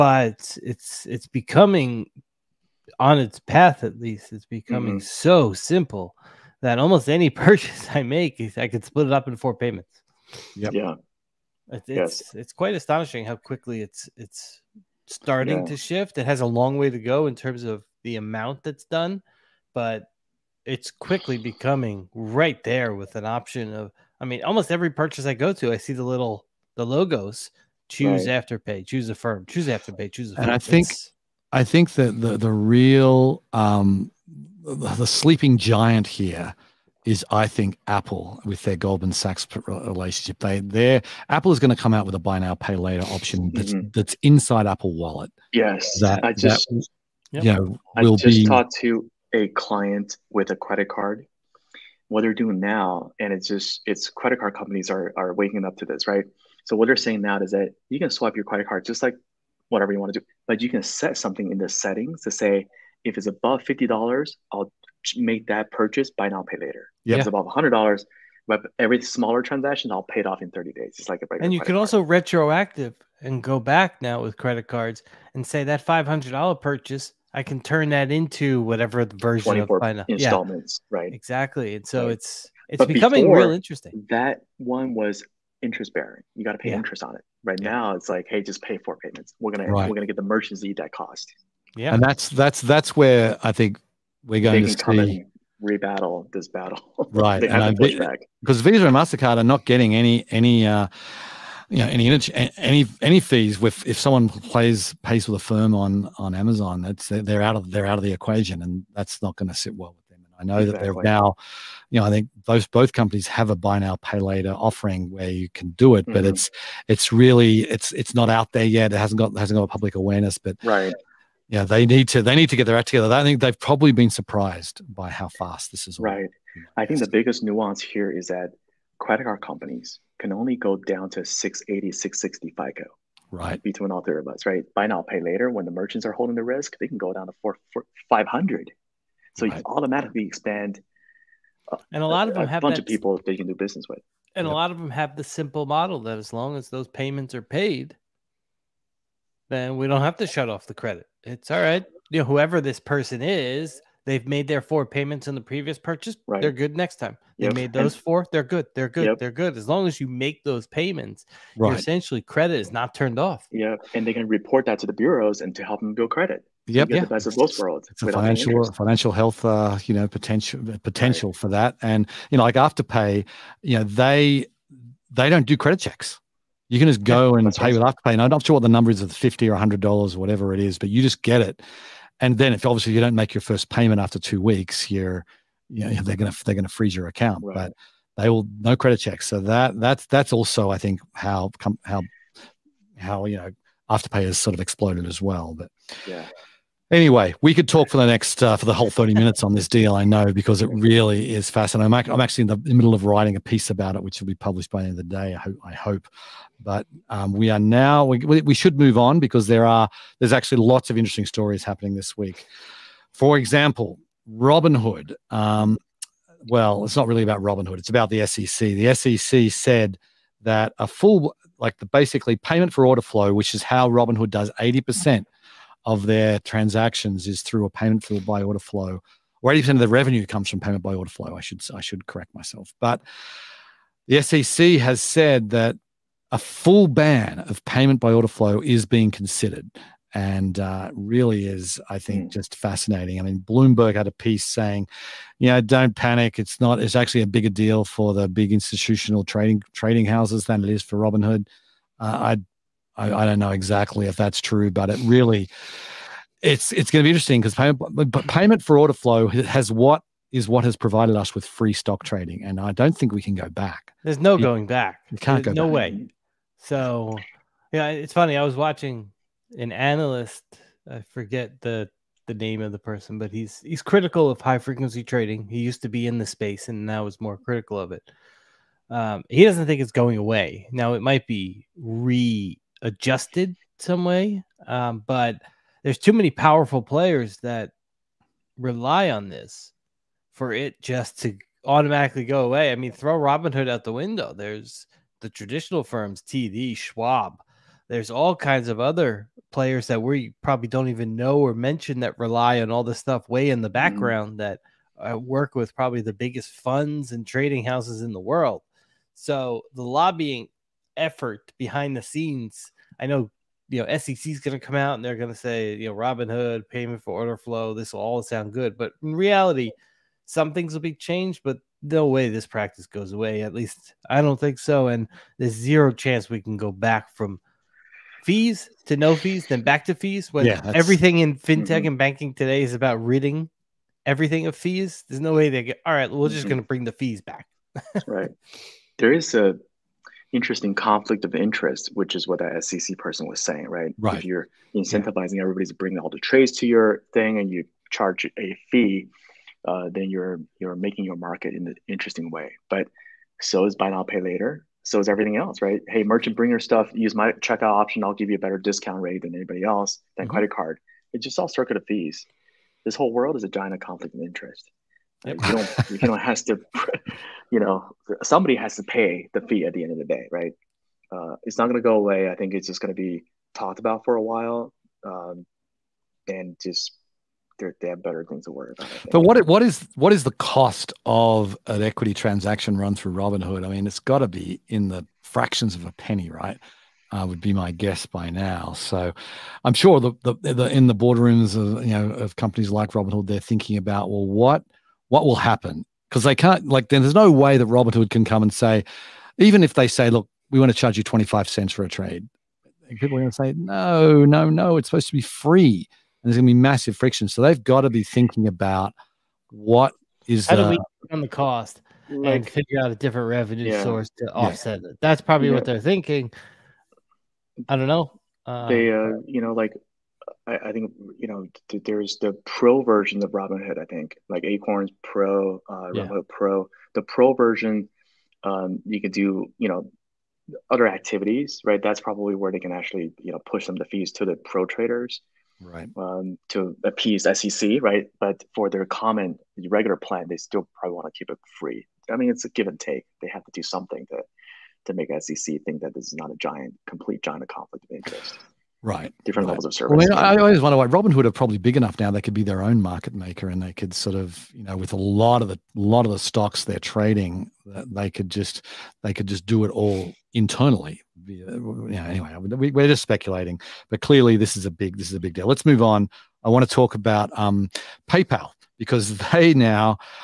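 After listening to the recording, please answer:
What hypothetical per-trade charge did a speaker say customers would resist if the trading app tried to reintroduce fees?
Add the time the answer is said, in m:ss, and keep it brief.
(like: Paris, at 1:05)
25 cents, at 6:41.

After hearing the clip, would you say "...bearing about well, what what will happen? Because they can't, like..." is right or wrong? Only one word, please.
wrong.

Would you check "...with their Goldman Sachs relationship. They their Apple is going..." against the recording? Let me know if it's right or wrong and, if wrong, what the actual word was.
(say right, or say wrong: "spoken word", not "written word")
right.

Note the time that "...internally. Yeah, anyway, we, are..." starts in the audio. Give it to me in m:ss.
7:40.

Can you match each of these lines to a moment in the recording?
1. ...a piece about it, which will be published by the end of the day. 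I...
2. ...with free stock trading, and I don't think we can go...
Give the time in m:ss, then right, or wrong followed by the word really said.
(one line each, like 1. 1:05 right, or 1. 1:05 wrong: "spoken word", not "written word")
1. 3:23 right
2. 4:21 right.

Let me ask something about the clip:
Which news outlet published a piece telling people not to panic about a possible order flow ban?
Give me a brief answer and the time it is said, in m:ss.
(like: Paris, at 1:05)
Bloomberg, at 4:03.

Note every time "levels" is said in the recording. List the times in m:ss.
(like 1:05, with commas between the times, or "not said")
7:29.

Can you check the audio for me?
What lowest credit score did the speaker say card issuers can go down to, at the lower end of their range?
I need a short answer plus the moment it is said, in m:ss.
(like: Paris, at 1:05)
660, at 2:11.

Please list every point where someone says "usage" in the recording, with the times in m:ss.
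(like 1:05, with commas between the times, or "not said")
not said.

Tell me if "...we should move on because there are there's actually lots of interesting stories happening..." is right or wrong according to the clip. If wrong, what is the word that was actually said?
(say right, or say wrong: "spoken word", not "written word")
right.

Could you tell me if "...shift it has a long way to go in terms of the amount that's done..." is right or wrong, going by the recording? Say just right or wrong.
right.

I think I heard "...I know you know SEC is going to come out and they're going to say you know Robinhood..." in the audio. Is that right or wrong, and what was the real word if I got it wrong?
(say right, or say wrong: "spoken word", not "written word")
right.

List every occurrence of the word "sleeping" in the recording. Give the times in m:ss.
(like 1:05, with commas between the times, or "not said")
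0:35.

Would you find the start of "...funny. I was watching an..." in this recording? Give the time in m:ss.
4:28.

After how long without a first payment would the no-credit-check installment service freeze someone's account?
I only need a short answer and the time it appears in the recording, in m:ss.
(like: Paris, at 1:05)
two weeks, at 3:04.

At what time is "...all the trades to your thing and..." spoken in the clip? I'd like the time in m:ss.
5:45.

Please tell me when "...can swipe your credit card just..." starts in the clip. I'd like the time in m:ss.
0:57.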